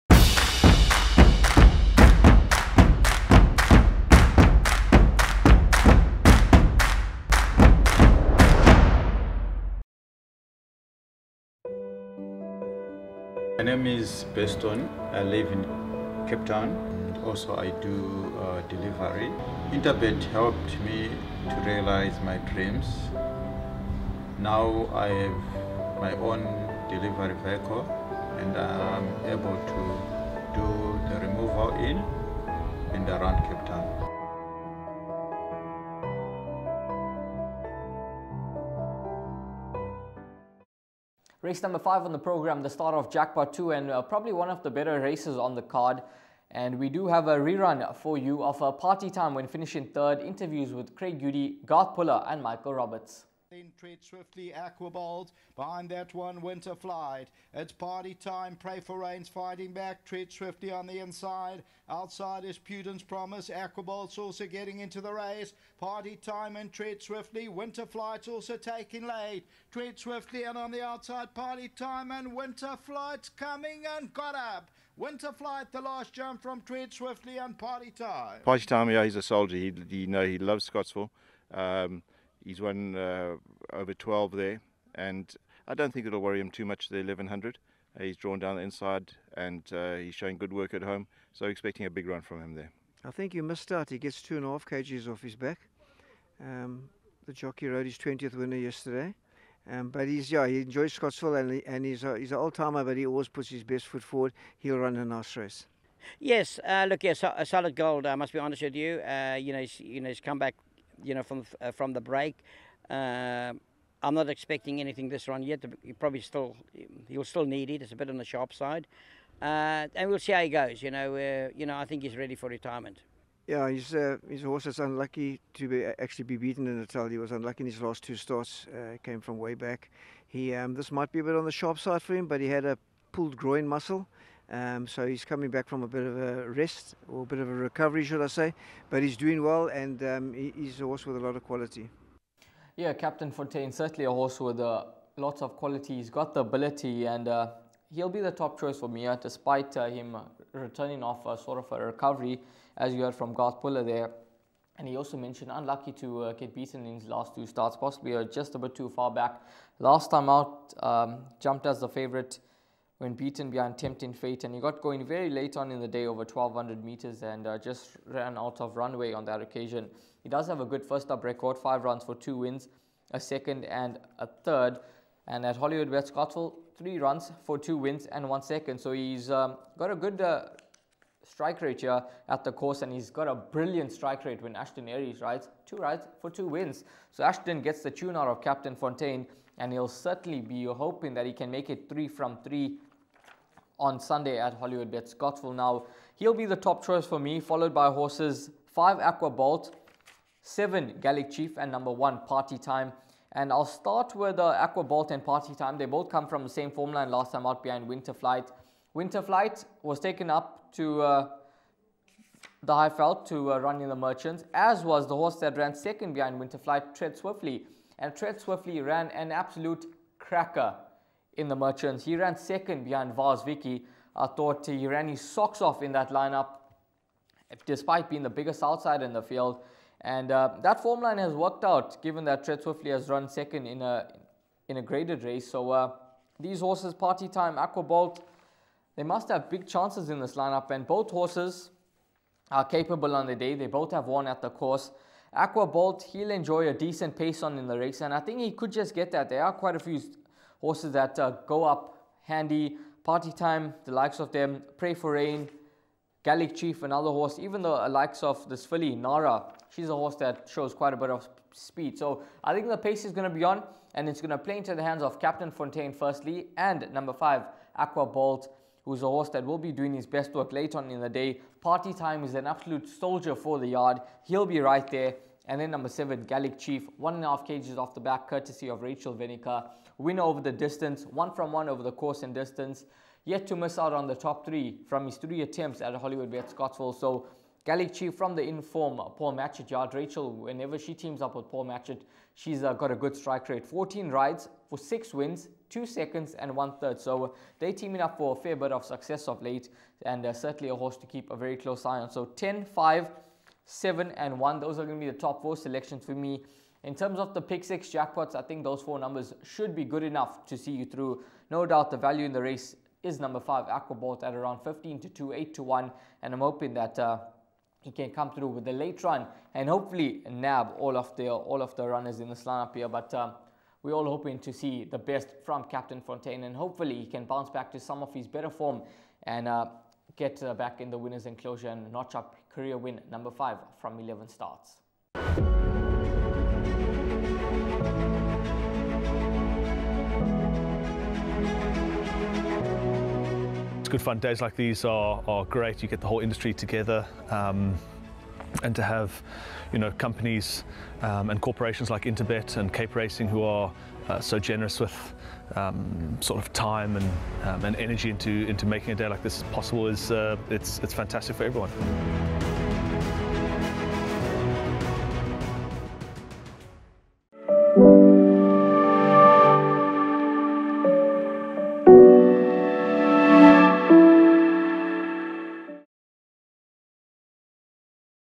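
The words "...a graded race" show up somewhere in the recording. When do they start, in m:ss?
3:54.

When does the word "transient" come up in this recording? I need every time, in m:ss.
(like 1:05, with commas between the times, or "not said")
not said.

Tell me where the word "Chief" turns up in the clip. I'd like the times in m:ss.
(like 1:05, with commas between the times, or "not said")
3:21, 4:16, 4:36, 4:47.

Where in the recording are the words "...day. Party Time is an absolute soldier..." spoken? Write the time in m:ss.
4:31.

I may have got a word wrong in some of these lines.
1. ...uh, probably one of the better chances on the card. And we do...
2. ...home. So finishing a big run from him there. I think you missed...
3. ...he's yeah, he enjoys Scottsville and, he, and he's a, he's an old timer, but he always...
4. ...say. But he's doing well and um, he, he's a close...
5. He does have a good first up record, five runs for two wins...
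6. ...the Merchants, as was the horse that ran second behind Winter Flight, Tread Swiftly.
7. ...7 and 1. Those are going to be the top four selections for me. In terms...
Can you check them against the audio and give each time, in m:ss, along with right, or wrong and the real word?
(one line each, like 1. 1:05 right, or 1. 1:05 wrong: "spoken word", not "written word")
1. 0:43 wrong: "races", not "chances"
2. 1:30 wrong: "expecting", not "finishing"
3. 1:40 right
4. 2:18 wrong: "horse", not "close"
5. 2:50 right
6. 3:33 right
7. 5:03 right.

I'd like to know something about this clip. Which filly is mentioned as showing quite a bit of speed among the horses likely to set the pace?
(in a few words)
Nara.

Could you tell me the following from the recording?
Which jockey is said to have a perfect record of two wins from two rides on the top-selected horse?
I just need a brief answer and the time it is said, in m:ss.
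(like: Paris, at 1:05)
Ashton Arries, at 3:04.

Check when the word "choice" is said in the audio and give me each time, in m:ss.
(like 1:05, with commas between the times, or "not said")
2:28, 3:16.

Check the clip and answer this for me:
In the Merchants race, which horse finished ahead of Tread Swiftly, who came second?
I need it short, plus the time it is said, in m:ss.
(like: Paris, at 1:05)
Vaz Vicky, at 3:43.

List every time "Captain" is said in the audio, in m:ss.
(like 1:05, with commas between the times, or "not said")
2:22, 3:08, 4:25, 5:25.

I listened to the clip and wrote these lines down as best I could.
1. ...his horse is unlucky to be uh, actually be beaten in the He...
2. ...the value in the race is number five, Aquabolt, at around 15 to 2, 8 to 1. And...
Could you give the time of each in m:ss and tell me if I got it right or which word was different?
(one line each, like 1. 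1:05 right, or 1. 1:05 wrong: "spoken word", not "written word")
1. 2:04 right
2. 5:11 right.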